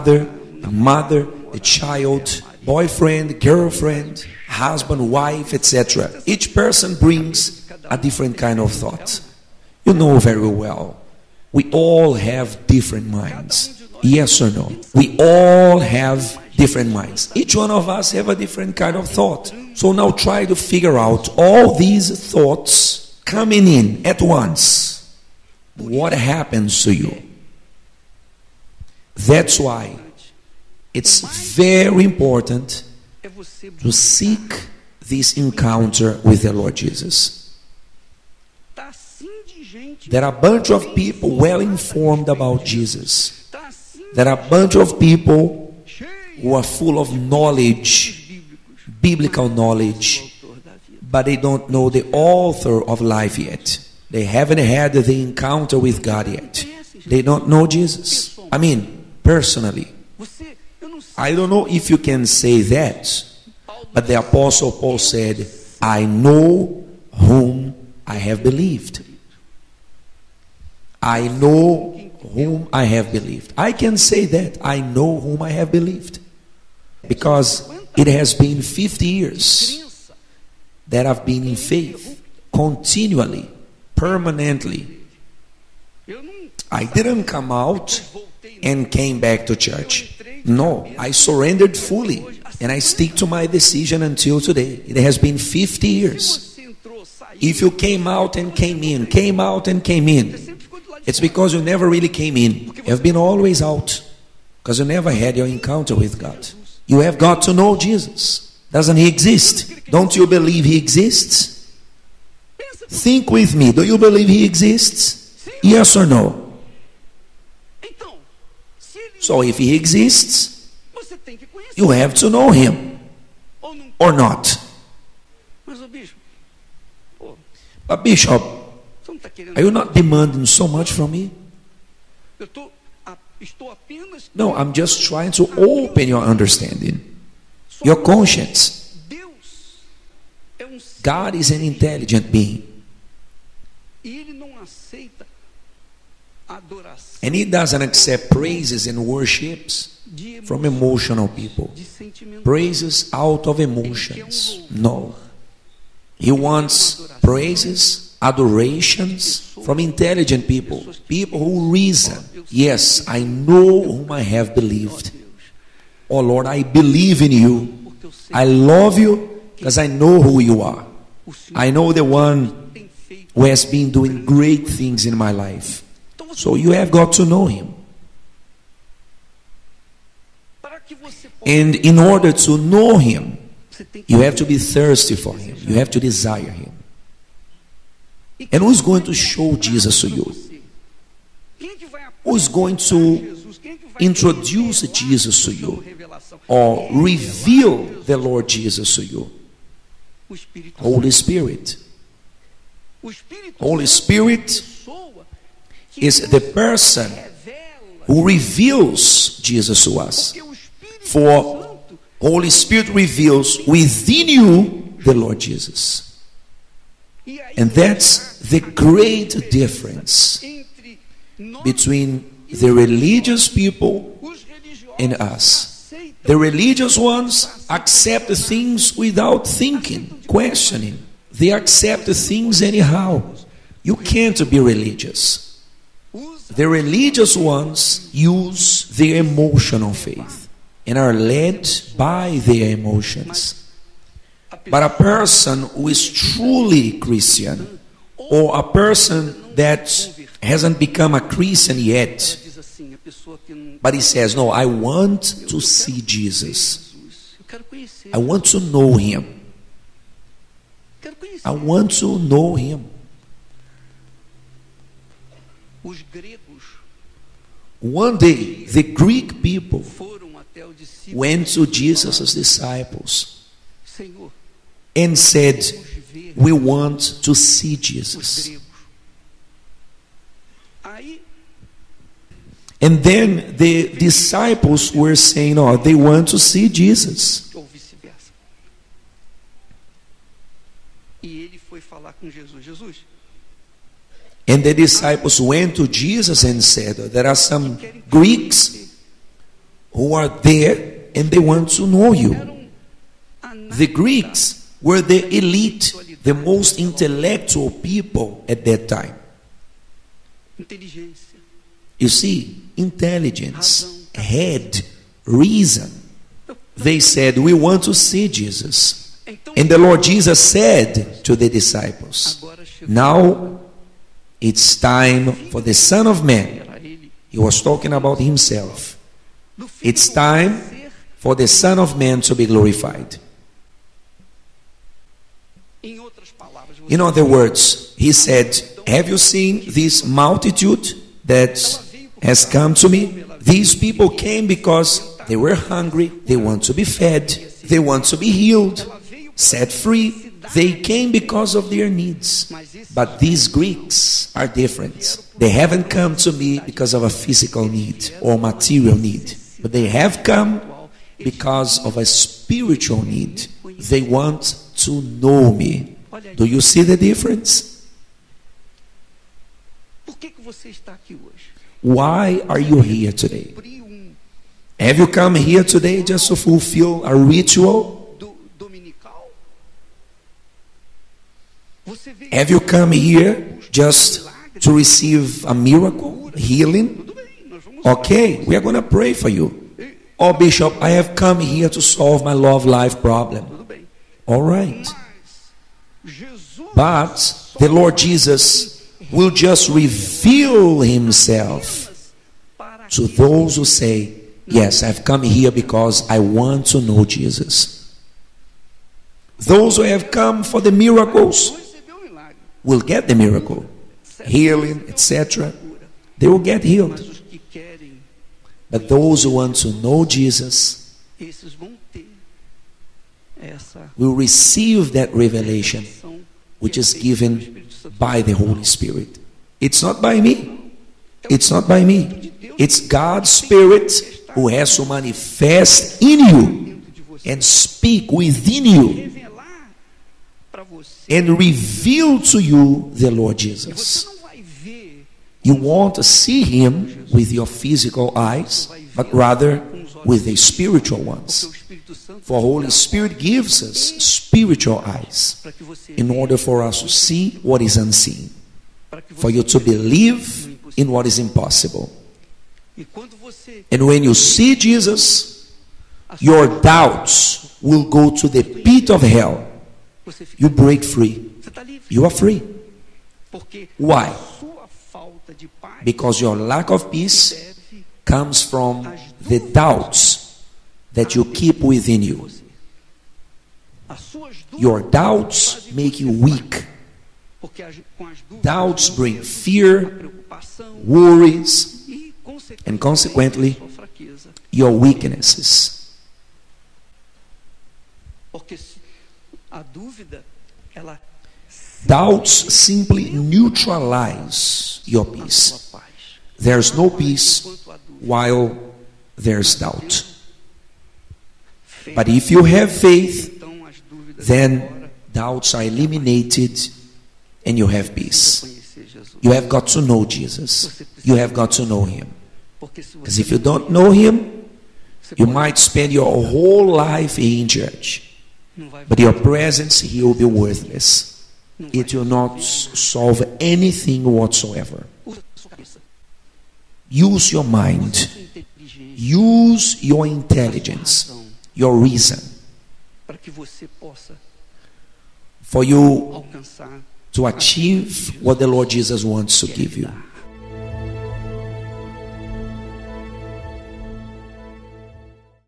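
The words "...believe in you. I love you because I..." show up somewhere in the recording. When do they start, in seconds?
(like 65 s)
166 s.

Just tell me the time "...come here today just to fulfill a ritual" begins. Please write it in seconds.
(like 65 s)
375 s.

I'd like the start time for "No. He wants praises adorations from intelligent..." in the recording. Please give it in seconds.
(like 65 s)
154 s.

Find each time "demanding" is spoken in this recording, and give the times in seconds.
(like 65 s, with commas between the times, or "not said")
129 s.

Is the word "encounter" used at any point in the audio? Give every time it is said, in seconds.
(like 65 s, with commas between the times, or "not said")
35 s, 55 s, 105 s.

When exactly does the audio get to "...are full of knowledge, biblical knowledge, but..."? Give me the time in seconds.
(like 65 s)
46 s.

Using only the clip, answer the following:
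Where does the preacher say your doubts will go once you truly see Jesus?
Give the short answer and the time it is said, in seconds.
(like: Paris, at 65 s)
The pit of hell, at 468 s.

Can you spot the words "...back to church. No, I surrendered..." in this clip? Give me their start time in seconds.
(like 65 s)
89 s.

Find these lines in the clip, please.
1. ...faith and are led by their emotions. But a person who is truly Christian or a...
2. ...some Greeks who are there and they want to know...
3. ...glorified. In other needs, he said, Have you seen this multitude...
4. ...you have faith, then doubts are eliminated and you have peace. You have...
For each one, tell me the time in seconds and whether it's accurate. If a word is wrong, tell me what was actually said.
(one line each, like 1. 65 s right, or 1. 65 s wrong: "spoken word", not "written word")
1. 239 s right
2. 297 s right
3. 332 s wrong: "words", not "needs"
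4. 512 s right.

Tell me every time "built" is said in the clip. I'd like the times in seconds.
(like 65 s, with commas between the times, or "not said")
not said.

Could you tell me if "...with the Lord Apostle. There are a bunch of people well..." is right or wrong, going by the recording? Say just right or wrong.
wrong.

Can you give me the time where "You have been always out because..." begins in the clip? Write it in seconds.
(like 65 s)
102 s.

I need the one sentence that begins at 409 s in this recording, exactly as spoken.
Those who have come for the miracles will get the miracle, healing, etc.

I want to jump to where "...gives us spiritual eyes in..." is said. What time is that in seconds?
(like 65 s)
453 s.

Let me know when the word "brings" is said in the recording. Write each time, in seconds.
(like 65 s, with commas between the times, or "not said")
6 s, 488 s.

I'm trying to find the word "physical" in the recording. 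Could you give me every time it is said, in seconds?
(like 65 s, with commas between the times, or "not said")
357 s, 447 s.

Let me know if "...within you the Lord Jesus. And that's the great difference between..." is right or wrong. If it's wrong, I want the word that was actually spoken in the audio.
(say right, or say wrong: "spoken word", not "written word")
right.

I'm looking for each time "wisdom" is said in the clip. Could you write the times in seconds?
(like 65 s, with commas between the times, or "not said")
not said.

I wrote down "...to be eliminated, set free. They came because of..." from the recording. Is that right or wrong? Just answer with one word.
wrong.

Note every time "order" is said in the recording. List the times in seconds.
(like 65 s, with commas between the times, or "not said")
181 s, 456 s.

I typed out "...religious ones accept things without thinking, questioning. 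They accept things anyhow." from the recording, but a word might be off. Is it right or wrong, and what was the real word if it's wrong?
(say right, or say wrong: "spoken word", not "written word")
right.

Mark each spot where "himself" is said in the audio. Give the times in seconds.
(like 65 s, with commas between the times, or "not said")
328 s, 400 s.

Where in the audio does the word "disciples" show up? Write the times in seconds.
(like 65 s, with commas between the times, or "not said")
272 s, 283 s, 294 s, 321 s.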